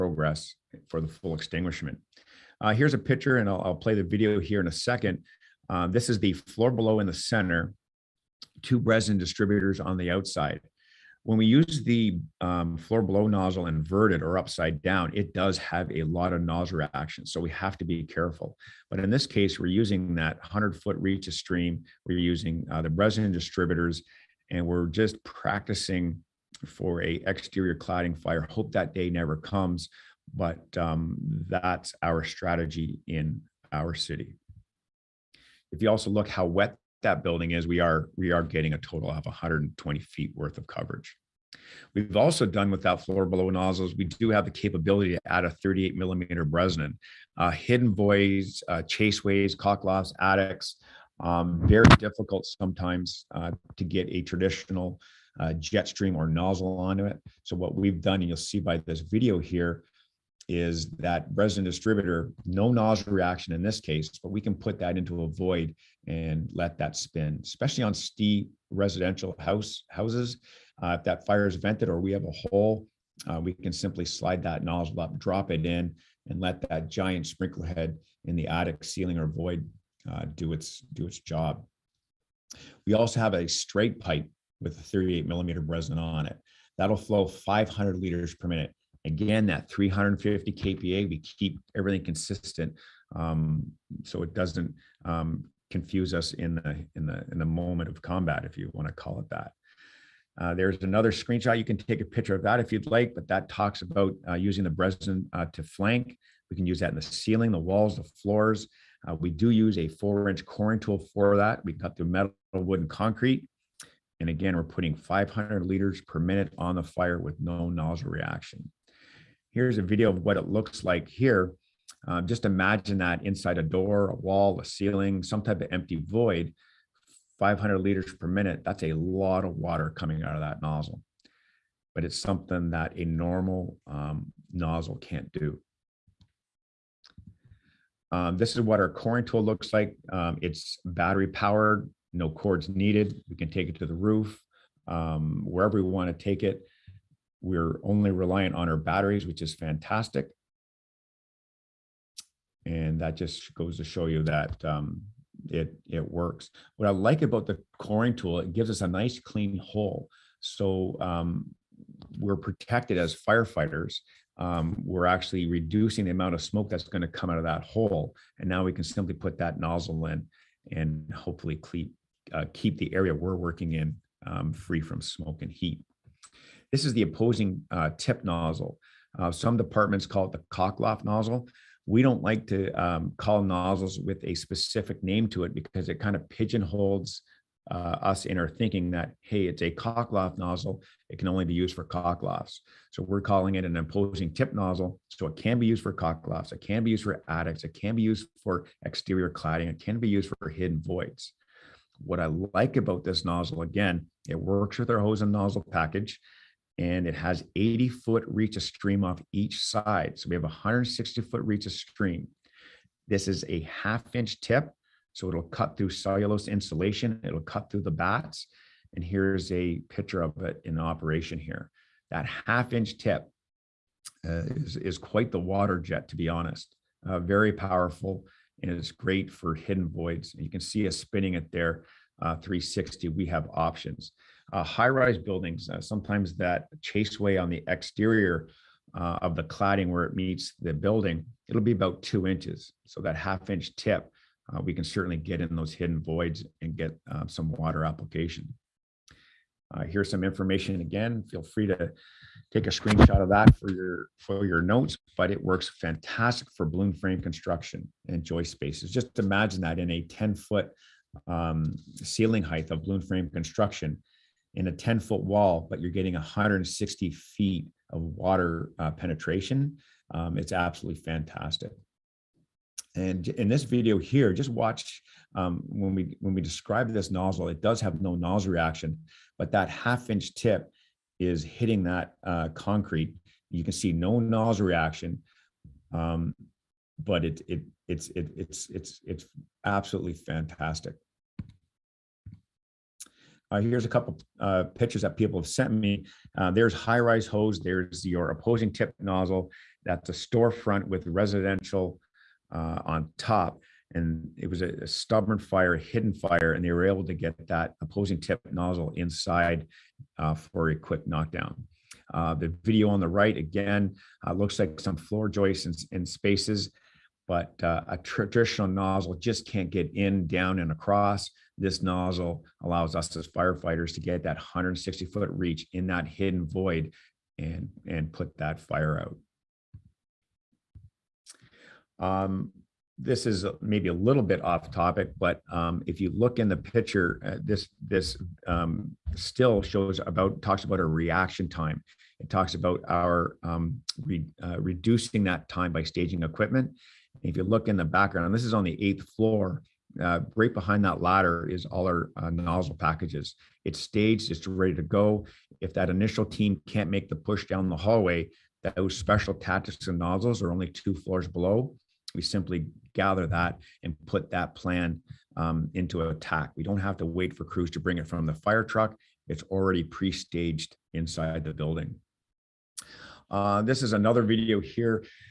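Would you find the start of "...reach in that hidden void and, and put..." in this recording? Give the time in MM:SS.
05:25.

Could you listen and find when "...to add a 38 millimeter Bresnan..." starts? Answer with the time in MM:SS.
00:45.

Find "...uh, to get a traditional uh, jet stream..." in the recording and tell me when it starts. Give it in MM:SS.
00:53.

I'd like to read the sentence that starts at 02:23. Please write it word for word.
We can take it to the roof, um, wherever we want to take it.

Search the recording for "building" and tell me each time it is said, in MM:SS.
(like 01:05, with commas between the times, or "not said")
00:37, 03:55, 04:00, 06:11.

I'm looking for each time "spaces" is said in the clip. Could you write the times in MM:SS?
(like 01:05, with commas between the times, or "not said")
04:18, 05:16.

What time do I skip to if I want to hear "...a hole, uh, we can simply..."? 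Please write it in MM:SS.
01:12.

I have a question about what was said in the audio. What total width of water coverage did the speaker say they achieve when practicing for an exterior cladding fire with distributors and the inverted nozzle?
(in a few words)
120 feet.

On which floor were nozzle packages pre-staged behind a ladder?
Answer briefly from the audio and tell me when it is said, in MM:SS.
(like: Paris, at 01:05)
8th floor, at 05:48.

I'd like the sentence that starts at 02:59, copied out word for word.
Uh, some departments call it the Cockloft nozzle.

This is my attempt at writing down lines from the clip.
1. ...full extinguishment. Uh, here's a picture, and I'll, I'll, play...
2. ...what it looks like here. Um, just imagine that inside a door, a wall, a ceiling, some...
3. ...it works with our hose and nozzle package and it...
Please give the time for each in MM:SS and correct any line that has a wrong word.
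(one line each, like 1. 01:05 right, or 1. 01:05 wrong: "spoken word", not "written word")
1. 00:01 right
2. 02:00 right
3. 03:24 right.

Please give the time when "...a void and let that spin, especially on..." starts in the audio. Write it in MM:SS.
01:05.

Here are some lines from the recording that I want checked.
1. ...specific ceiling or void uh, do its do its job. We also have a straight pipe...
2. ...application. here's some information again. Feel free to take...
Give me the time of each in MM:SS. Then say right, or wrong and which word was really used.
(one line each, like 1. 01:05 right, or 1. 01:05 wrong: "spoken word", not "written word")
1. 01:18 wrong: "attic", not "specific"
2. 04:07 right.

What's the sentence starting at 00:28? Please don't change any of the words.
Hope that day never comes, but um, that's our strategy in our city.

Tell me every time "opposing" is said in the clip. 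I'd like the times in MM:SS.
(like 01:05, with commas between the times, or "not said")
02:57, 03:13, 04:58, 05:07.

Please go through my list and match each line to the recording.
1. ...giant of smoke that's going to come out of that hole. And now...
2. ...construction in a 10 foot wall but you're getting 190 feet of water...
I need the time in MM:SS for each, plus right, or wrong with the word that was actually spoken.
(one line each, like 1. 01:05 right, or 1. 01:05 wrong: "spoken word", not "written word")
1. 02:46 wrong: "amount", not "giant"
2. 04:23 wrong: "160", not "190".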